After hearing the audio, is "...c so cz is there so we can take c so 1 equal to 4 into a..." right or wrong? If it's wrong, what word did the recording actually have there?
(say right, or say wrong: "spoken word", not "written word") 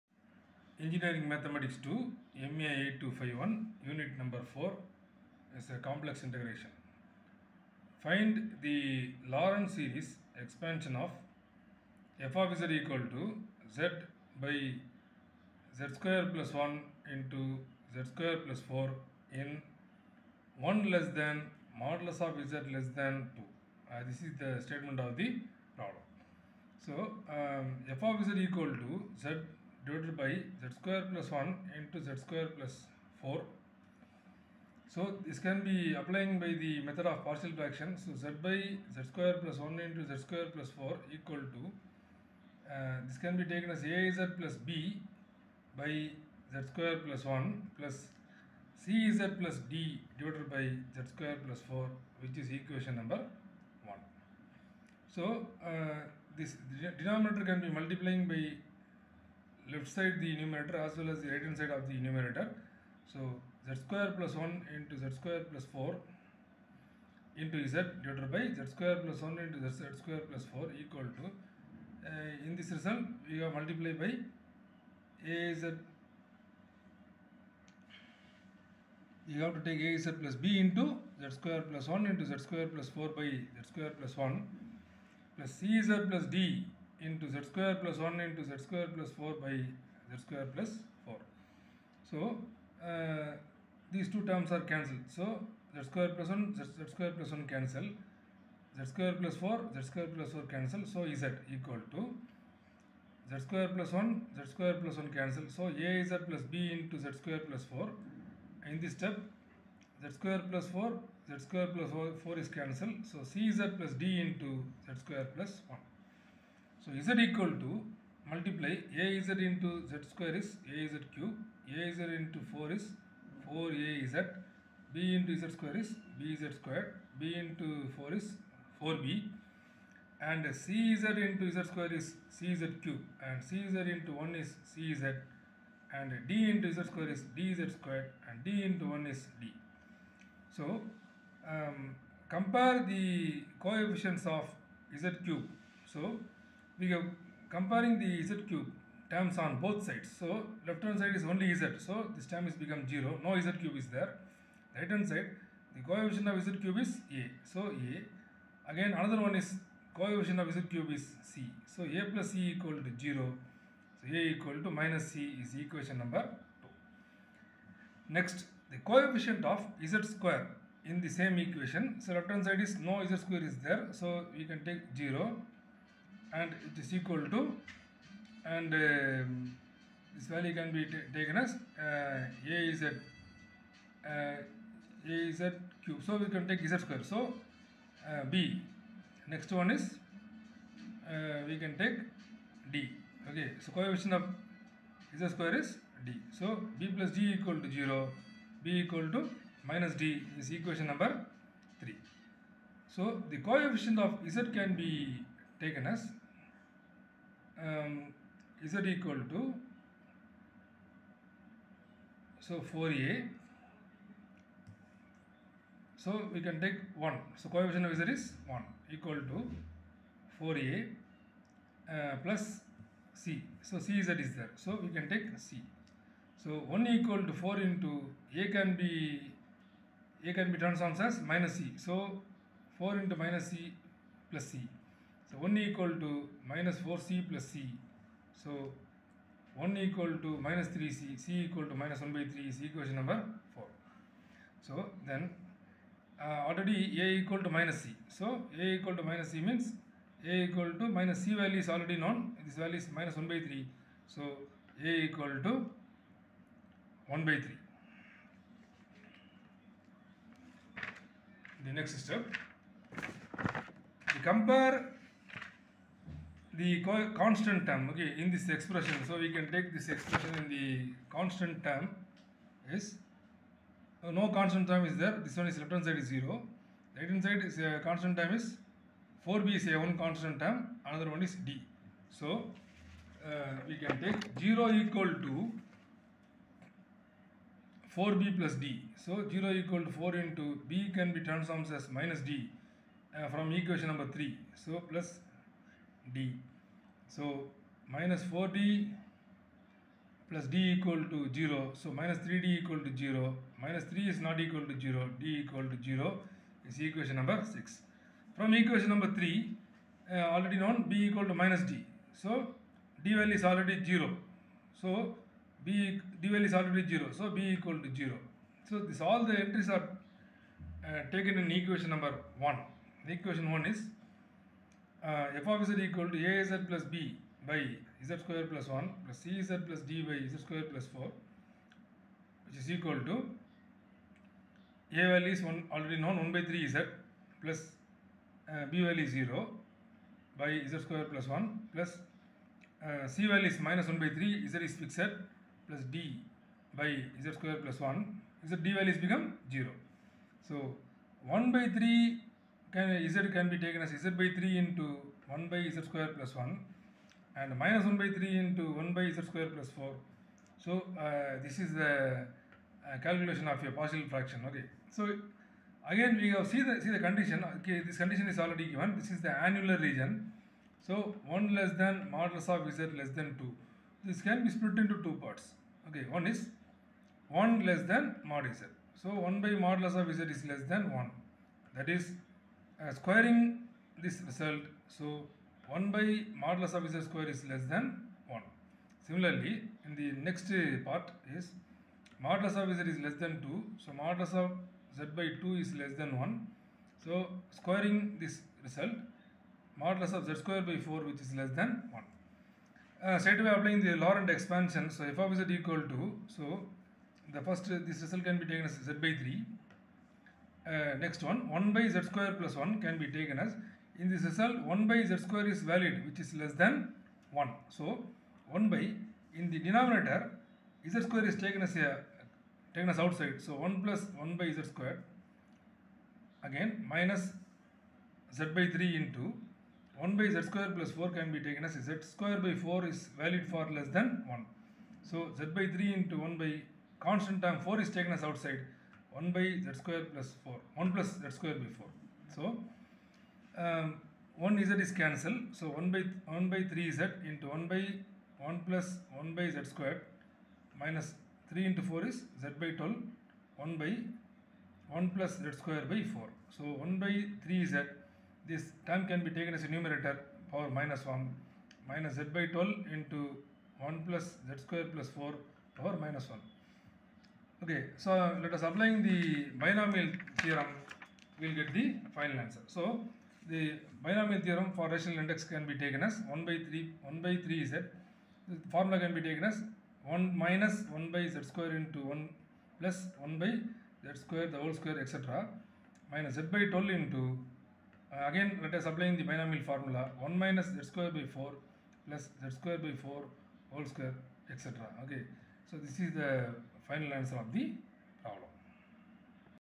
right.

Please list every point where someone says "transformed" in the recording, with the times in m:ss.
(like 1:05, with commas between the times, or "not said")
3:50, 4:51.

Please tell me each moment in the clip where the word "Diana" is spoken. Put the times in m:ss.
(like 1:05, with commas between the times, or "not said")
not said.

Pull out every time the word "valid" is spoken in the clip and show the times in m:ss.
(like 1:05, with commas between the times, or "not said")
6:55, 7:13.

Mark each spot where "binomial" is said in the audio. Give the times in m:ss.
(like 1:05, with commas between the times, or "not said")
7:49, 7:54, 8:09.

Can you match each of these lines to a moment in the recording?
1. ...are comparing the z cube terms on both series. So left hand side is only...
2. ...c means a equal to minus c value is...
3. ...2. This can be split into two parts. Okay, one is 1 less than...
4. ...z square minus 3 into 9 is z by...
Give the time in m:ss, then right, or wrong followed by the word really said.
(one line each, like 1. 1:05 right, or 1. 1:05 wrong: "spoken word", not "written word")
1. 2:26 wrong: "sides", not "series"
2. 4:09 right
3. 6:13 right
4. 7:29 wrong: "4", not "9".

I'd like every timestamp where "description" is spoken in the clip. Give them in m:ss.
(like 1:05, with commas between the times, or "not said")
not said.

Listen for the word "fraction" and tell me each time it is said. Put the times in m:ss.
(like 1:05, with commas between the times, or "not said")
0:37, 6:04.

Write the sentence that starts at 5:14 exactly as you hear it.
So b d value is already 0.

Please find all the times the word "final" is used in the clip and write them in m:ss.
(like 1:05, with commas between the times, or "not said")
7:52, 8:16.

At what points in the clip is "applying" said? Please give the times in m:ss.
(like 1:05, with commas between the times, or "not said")
0:35, 6:43, 7:48, 8:08.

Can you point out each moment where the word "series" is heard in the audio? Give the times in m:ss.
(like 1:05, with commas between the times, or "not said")
0:09.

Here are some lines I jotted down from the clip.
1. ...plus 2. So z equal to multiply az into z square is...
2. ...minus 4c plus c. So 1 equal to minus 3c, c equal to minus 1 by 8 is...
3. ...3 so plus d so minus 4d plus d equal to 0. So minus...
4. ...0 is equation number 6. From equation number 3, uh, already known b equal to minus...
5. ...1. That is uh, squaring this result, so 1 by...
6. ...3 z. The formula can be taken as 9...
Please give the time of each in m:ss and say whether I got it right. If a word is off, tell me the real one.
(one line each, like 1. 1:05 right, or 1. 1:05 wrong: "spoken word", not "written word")
1. 1:55 wrong: "1", not "2"
2. 3:56 wrong: "3", not "8"
3. 4:54 right
4. 5:05 right
5. 6:20 right
6. 7:57 wrong: "1", not "9".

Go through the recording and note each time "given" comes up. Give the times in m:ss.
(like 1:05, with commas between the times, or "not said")
6:08.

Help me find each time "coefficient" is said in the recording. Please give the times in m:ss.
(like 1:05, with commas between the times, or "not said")
2:23, 2:35, 2:39, 2:48, 3:13, 3:23, 3:37.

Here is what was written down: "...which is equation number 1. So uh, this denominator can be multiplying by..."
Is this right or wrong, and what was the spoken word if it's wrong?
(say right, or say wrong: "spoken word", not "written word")
right.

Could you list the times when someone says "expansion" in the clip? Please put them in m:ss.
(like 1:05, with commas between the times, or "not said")
0:10, 6:44.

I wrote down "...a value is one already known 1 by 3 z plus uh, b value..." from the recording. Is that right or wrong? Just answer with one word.
right.